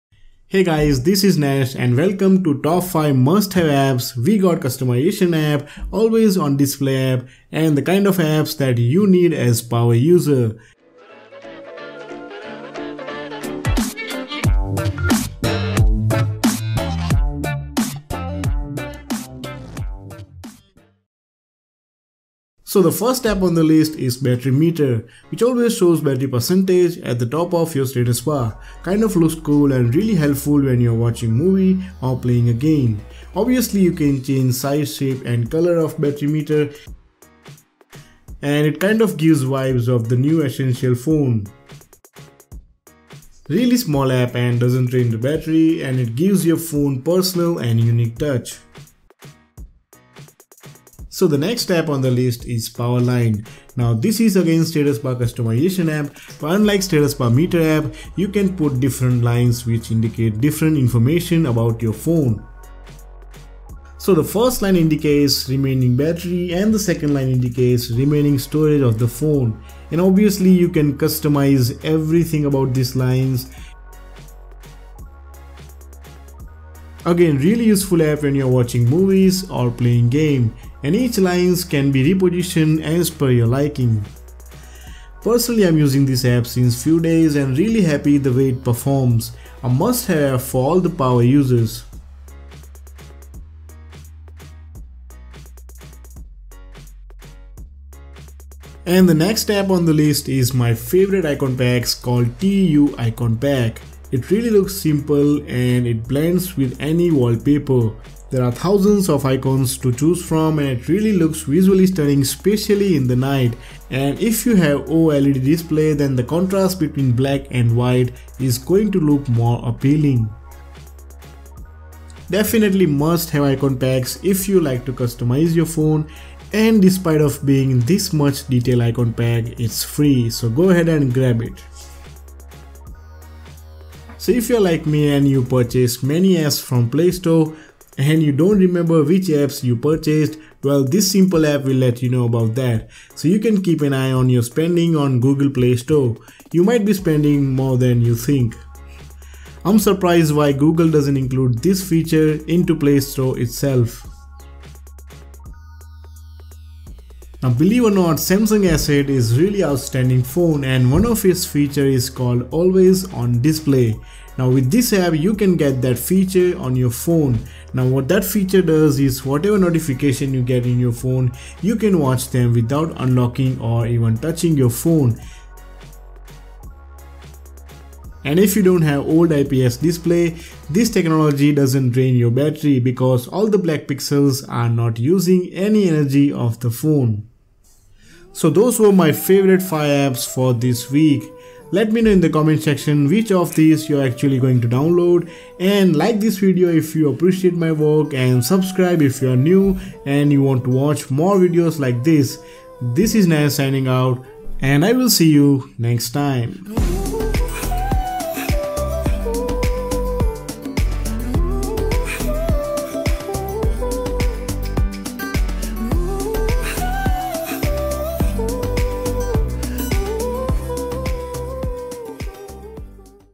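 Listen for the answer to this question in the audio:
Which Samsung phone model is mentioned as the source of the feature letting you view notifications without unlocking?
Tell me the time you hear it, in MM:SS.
02:38.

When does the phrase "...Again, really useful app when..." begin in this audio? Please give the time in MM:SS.
01:17.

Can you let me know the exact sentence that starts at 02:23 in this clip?
So you can keep an eye on your spending on Google Play Store.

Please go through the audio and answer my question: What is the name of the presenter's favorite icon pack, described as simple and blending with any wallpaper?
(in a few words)
TU Icon Pack.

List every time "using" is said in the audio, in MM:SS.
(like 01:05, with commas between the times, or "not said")
01:25, 03:04.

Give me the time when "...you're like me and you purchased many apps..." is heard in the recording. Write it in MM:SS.
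02:14.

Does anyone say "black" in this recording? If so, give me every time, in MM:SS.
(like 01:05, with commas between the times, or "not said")
01:57, 03:03.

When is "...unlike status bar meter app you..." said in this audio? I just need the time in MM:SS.
00:56.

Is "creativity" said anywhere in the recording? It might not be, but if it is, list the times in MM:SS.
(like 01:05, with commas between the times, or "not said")
not said.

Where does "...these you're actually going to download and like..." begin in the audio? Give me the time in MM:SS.
03:13.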